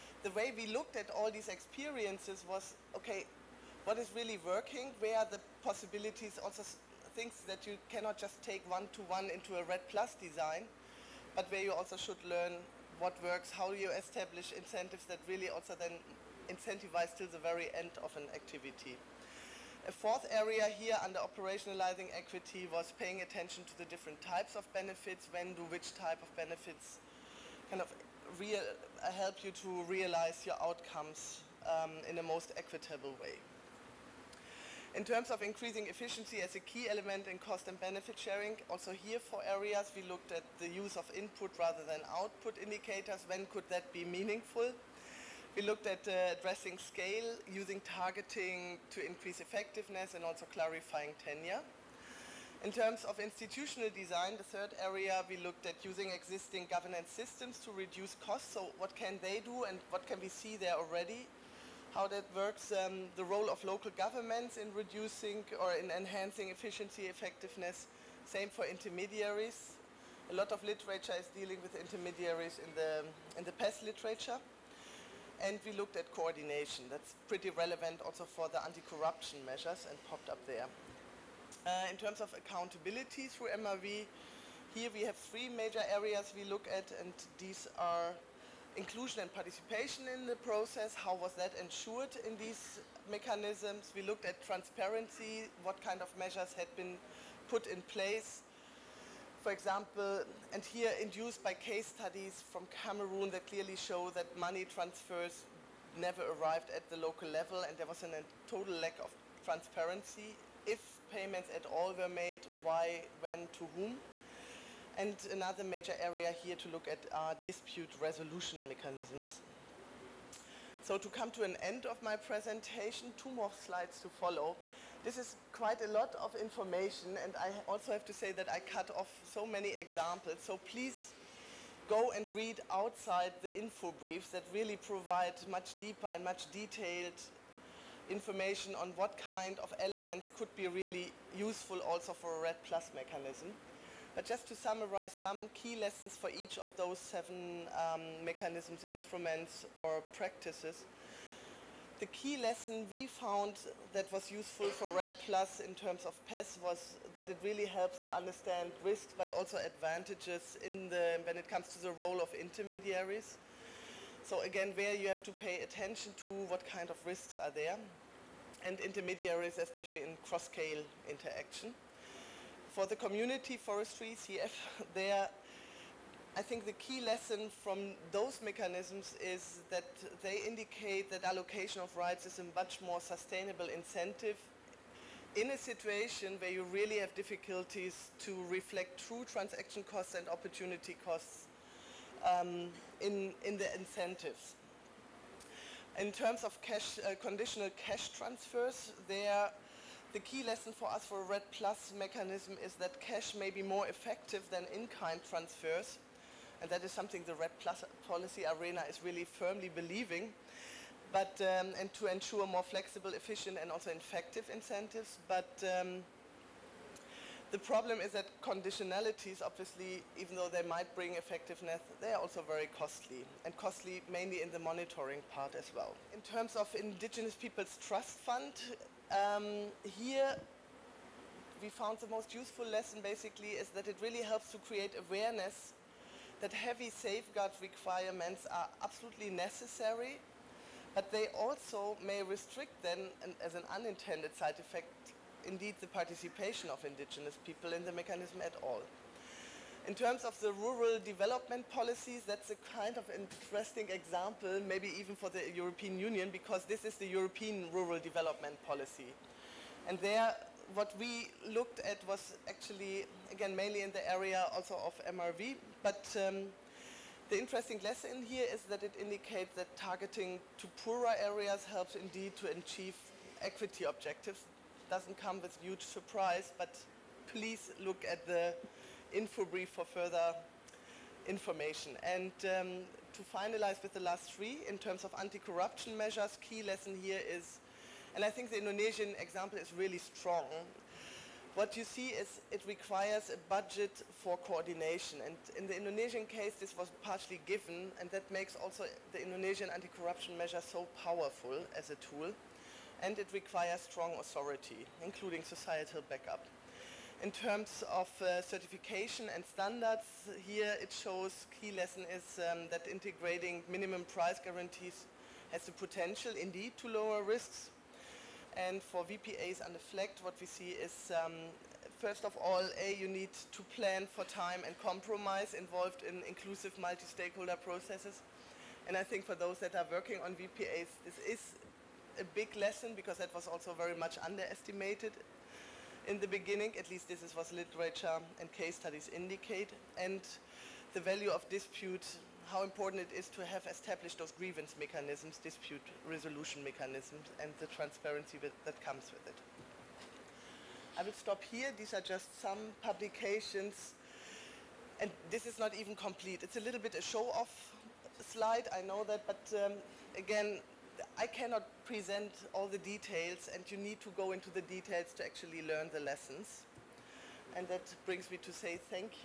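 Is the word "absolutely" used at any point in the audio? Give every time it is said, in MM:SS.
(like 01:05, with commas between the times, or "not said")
03:58.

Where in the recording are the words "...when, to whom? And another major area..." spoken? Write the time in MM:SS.
01:53.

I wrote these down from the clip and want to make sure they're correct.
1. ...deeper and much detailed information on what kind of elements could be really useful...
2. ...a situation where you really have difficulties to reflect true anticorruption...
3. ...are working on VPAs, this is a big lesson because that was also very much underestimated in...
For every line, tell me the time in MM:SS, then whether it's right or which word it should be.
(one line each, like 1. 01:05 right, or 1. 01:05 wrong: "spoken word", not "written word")
1. 02:15 right
2. 03:05 wrong: "transaction", not "anticorruption"
3. 05:29 right.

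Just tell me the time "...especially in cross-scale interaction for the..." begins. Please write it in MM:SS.
02:49.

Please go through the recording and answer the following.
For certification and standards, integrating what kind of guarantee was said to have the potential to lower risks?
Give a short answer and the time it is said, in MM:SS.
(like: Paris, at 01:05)
minimum price guarantees, at 05:13.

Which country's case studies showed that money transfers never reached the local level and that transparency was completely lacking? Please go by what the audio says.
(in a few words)
Cameroon.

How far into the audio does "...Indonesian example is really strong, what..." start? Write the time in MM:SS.
04:48.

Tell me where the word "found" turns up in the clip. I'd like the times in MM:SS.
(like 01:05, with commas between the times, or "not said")
02:33, 03:51.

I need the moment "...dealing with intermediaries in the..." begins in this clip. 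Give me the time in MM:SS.
01:11.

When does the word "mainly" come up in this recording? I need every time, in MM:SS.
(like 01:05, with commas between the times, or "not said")
03:44, 04:23.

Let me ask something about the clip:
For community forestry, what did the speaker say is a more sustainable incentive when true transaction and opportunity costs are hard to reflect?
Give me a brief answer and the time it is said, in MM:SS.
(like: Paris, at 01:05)
allocation of rights, at 03:01.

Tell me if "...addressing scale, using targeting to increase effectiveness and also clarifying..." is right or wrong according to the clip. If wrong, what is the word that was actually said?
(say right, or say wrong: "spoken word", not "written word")
right.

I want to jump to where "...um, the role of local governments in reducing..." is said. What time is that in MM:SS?
01:02.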